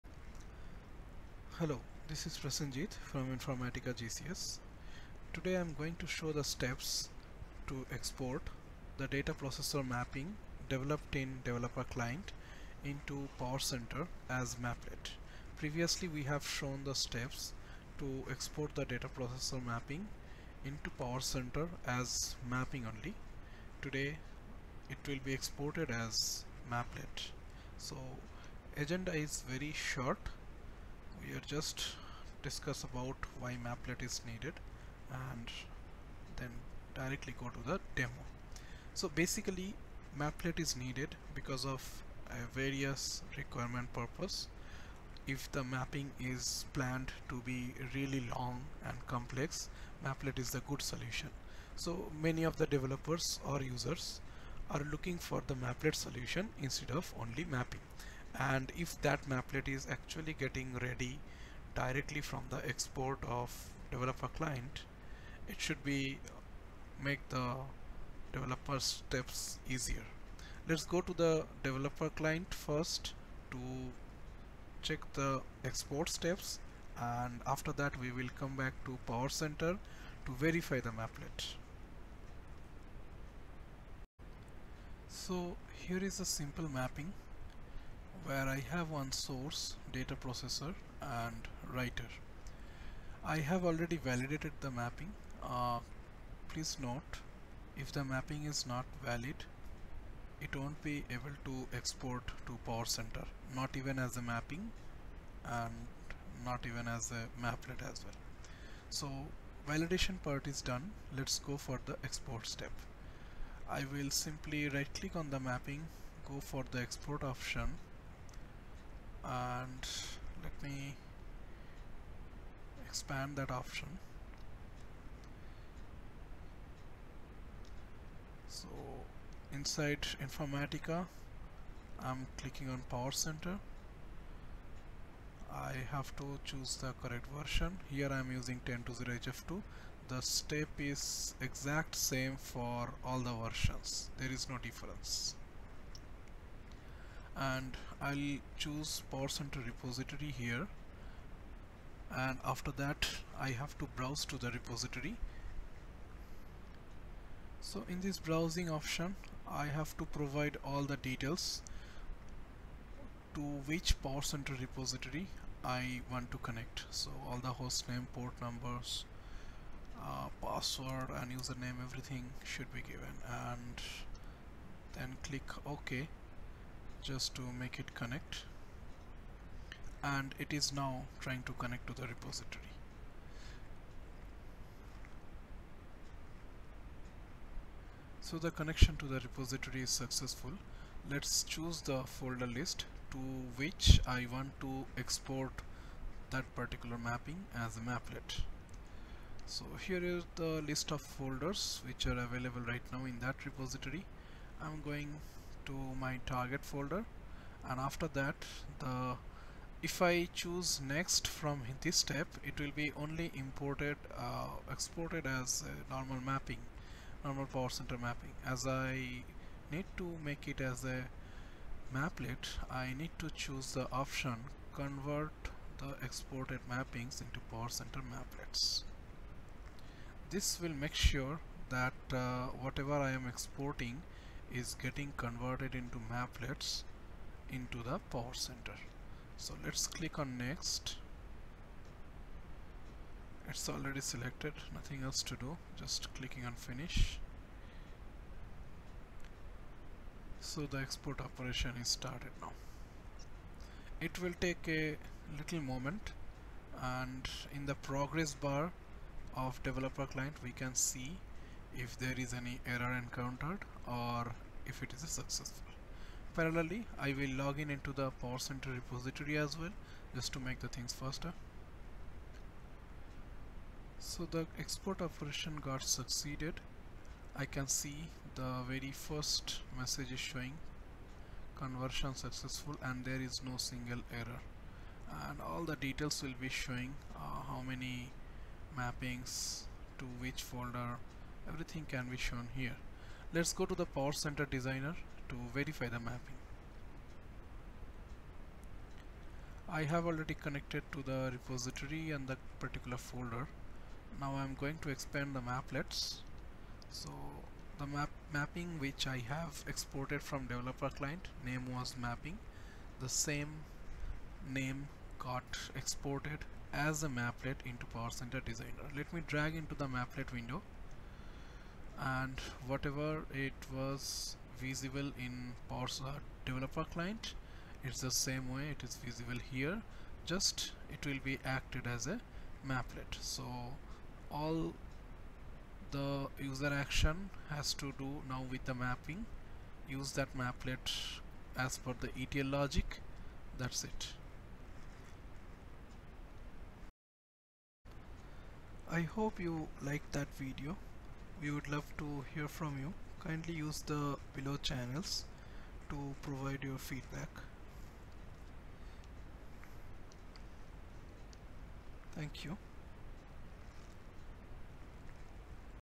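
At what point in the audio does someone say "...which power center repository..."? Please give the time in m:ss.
2:43.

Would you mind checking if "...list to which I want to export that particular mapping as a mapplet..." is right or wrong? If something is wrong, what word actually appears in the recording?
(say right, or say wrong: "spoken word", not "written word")
right.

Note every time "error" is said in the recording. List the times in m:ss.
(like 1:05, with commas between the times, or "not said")
4:22, 4:44.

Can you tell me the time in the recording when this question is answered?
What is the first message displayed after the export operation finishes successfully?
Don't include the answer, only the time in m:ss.
4:41.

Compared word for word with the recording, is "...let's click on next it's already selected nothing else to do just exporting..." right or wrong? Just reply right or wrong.
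wrong.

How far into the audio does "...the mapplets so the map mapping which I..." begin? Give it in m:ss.
5:05.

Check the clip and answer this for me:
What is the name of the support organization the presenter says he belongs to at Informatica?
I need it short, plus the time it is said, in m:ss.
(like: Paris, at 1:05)
GCS, at 0:03.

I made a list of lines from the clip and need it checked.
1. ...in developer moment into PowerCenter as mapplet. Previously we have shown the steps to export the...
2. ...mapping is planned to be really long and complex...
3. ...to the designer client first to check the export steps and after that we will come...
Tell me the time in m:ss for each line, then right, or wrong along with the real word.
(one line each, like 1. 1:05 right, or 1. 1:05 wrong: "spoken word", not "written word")
1. 0:11 wrong: "client", not "moment"
2. 0:45 right
3. 1:11 wrong: "developer", not "designer".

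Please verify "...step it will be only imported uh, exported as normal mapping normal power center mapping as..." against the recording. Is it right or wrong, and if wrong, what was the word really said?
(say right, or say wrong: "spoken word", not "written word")
right.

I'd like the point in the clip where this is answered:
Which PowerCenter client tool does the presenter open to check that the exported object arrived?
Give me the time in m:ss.
4:53.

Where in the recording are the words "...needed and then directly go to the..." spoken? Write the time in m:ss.
0:34.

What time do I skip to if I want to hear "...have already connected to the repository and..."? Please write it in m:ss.
4:59.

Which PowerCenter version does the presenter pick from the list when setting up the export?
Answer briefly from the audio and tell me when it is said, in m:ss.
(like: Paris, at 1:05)
10 HF2, at 2:18.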